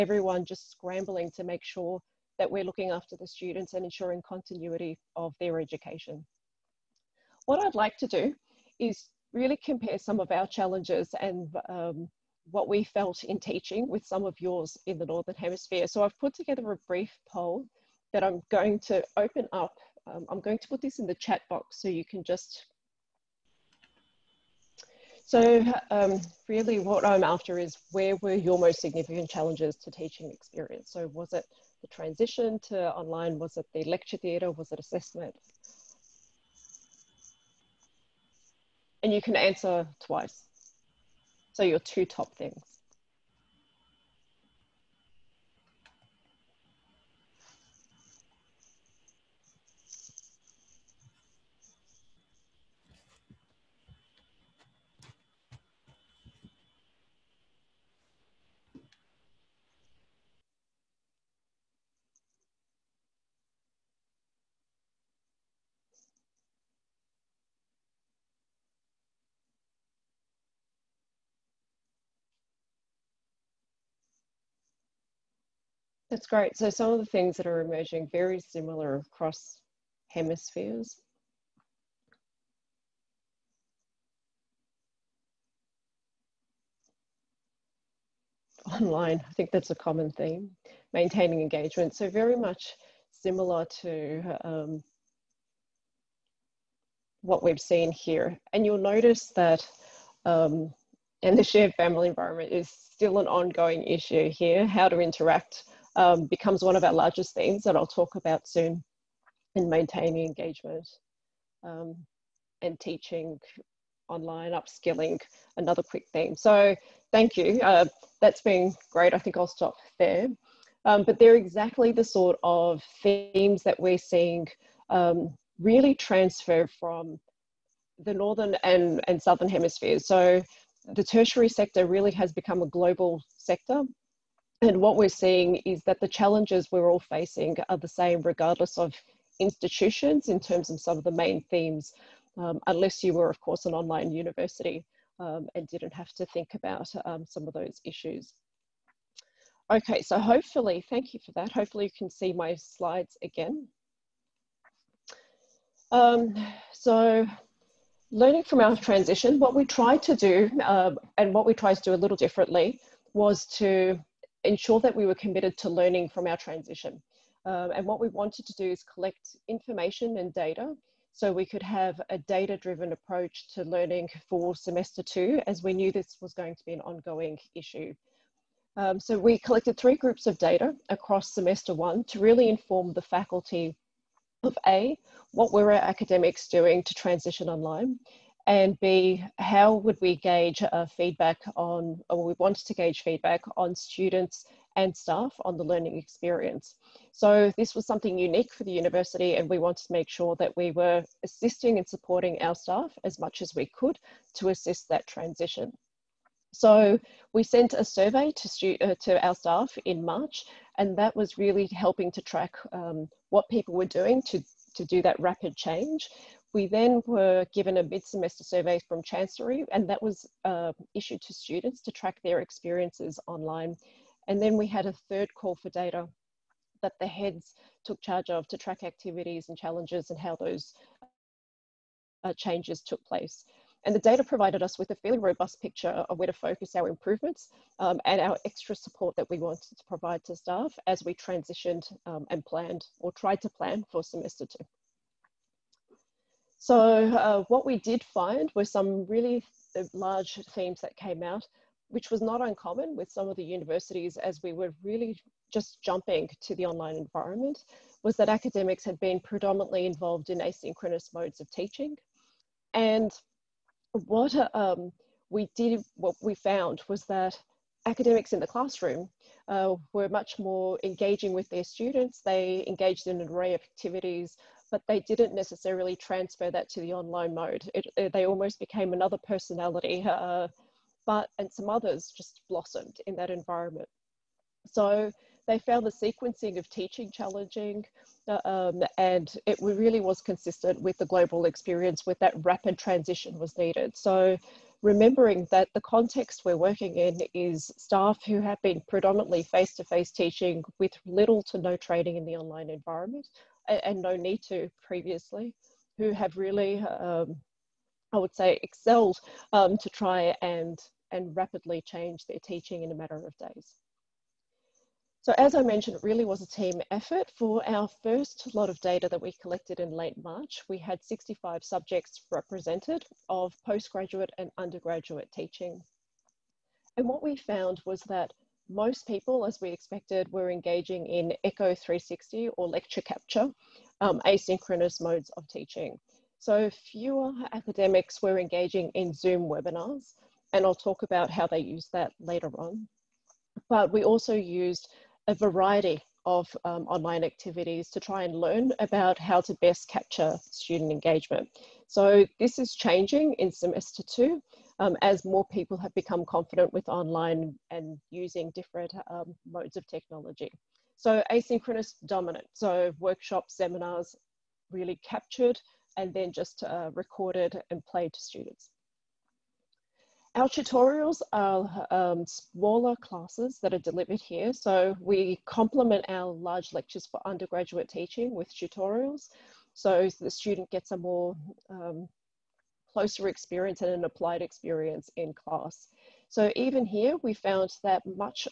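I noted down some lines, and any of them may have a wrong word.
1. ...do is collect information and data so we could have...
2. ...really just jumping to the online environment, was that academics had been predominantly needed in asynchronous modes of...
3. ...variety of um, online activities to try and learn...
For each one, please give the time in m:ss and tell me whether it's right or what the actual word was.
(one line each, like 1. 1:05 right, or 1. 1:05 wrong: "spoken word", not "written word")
1. 2:48 right
2. 4:14 wrong: "involved", not "needed"
3. 5:45 right.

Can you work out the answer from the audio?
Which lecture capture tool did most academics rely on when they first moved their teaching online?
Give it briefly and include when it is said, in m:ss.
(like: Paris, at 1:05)
Echo 360, at 5:31.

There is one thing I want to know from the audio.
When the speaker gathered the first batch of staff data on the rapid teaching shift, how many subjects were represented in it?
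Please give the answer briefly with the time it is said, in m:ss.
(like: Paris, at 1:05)
65, at 5:21.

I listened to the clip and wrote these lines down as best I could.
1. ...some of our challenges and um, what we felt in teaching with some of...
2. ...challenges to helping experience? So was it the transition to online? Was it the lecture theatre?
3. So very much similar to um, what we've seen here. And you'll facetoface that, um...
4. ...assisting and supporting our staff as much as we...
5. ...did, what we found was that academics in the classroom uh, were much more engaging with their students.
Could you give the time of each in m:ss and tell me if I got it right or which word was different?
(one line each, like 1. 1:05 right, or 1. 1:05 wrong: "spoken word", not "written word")
1. 0:09 right
2. 0:29 wrong: "teaching", not "helping"
3. 1:31 wrong: "notice", not "facetoface"
4. 3:21 right
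5. 4:25 right.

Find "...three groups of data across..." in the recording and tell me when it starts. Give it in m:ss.
2:59.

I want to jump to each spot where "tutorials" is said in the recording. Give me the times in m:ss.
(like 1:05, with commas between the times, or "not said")
6:10, 6:18.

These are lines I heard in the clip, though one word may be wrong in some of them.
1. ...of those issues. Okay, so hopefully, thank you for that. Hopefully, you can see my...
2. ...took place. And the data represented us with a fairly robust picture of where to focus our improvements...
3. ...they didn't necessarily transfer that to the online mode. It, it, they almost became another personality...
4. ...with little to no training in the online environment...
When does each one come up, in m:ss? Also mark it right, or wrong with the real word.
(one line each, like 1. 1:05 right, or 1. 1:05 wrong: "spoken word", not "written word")
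1. 2:27 right
2. 3:52 wrong: "provided", not "represented"
3. 4:34 right
4. 5:00 right.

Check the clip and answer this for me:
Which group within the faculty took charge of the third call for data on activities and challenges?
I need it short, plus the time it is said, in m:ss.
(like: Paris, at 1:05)
The heads, at 3:46.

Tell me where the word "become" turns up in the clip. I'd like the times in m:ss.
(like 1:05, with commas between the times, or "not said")
1:46, 2:12, 5:55.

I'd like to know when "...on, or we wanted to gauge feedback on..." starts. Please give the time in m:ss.
3:11.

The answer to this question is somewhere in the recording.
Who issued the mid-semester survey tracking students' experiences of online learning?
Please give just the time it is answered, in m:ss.
3:39.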